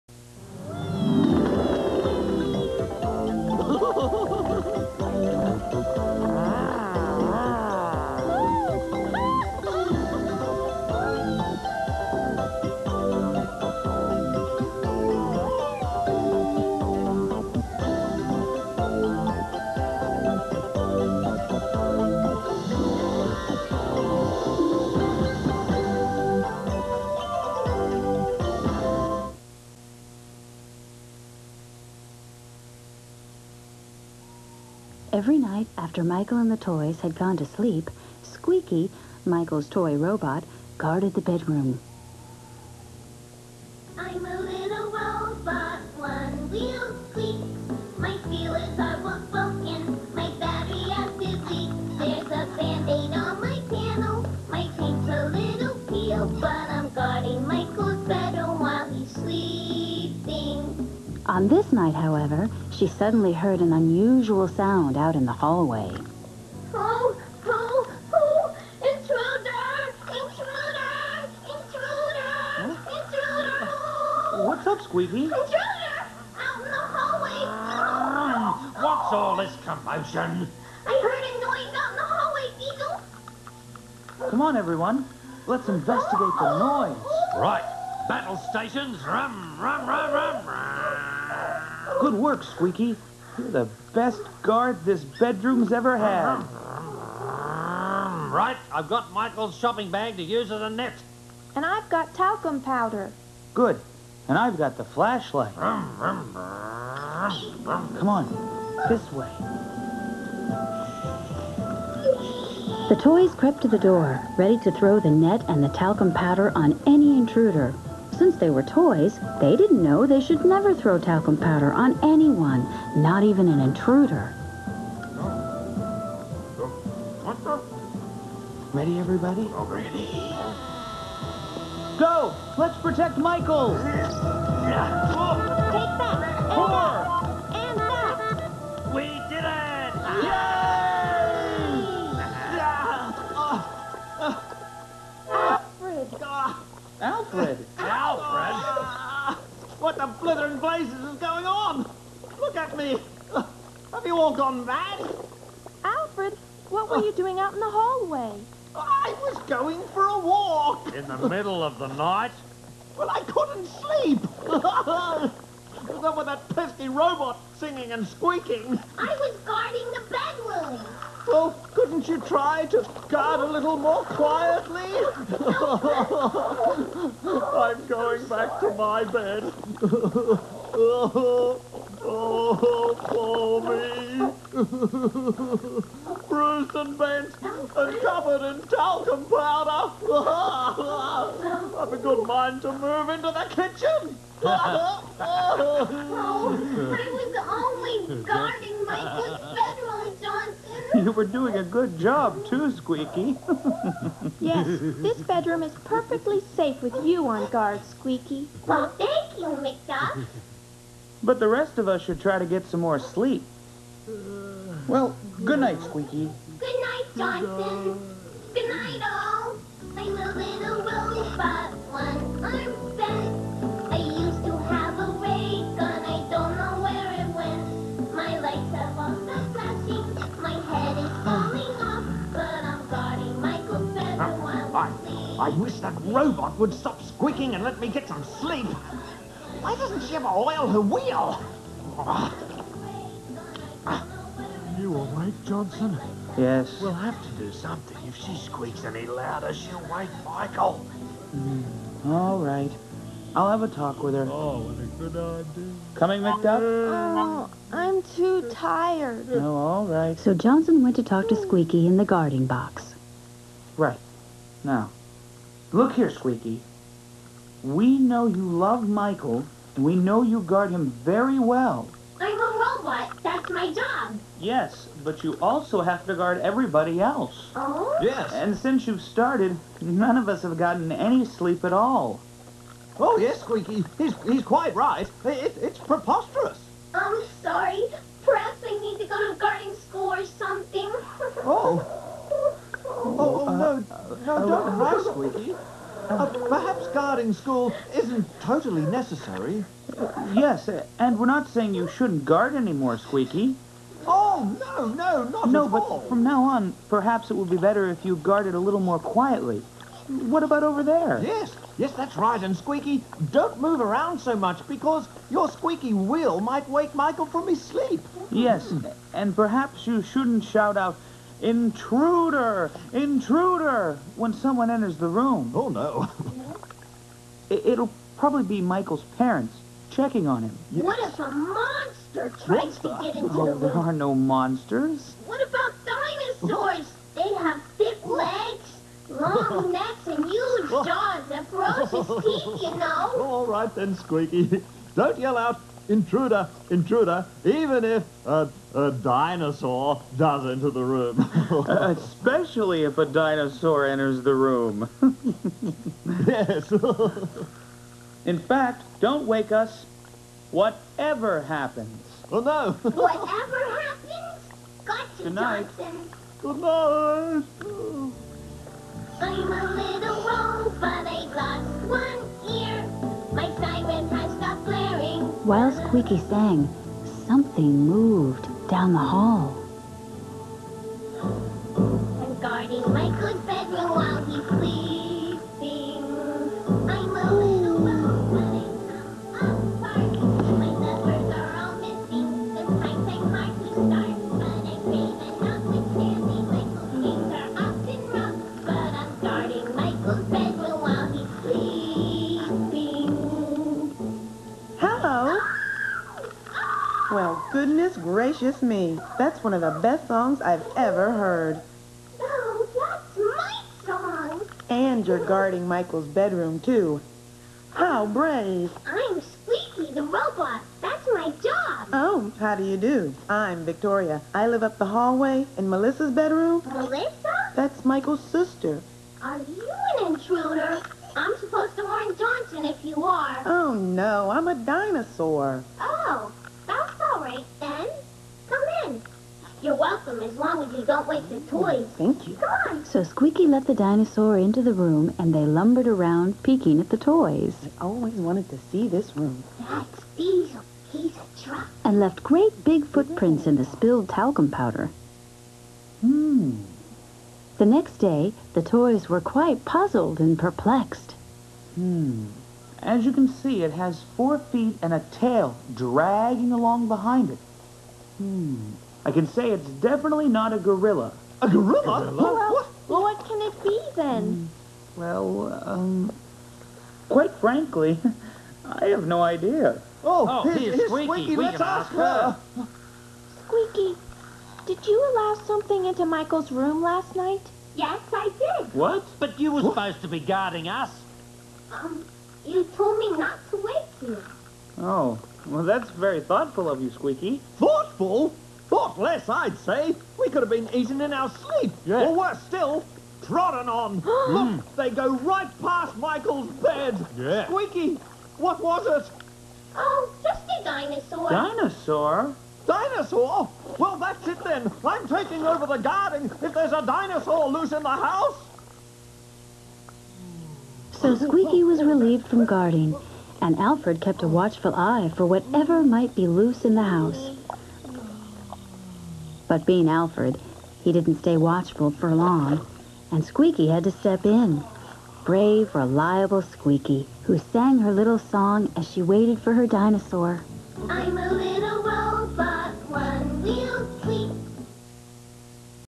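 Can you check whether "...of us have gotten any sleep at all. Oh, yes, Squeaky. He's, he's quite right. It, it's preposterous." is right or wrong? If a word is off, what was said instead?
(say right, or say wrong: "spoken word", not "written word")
right.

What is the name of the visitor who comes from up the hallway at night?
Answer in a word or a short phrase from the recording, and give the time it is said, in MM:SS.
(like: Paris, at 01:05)
Victoria, at 07:03.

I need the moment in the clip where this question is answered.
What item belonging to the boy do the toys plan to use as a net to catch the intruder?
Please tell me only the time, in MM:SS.
01:39.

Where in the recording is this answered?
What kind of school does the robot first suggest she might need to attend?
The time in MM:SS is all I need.
04:49.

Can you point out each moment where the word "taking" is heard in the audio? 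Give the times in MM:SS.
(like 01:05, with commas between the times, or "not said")
08:35.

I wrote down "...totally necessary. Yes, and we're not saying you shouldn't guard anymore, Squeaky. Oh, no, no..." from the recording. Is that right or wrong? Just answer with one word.
right.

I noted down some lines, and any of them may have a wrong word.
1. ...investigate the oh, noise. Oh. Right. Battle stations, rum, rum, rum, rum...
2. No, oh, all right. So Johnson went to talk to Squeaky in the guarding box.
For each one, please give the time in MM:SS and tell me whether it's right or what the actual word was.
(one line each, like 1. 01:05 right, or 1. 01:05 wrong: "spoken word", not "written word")
1. 01:25 right
2. 04:19 right.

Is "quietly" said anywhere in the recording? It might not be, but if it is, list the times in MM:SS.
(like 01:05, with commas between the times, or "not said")
02:54, 05:08.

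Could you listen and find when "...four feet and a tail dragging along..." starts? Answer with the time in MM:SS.
07:44.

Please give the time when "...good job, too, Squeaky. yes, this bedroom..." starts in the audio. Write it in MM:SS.
03:21.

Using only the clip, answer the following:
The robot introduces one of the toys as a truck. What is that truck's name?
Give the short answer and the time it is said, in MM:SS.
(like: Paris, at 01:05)
Diesel, at 07:30.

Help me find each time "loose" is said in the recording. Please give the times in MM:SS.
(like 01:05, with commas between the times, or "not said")
08:37, 08:46.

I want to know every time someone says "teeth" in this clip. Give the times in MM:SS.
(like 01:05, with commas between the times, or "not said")
05:42.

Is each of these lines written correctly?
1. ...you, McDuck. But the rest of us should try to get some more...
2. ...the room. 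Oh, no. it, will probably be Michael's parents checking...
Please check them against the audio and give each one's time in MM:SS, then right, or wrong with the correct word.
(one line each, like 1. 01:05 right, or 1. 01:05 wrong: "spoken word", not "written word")
1. 03:29 right
2. 05:24 right.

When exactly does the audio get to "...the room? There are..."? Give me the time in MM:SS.
05:33.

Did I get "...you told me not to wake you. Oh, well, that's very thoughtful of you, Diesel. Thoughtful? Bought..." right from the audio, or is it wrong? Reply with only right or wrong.
wrong.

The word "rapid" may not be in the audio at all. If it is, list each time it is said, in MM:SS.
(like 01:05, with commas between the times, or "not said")
not said.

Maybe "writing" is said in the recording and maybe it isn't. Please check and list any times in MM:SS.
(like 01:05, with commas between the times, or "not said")
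not said.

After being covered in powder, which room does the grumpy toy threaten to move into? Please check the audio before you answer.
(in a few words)
The kitchen.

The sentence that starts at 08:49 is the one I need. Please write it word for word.
But being Alfred, he didn't stay watchful for long, and Squeaky had to step in.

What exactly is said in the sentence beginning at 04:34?
Yes, but you also have to guard everybody else.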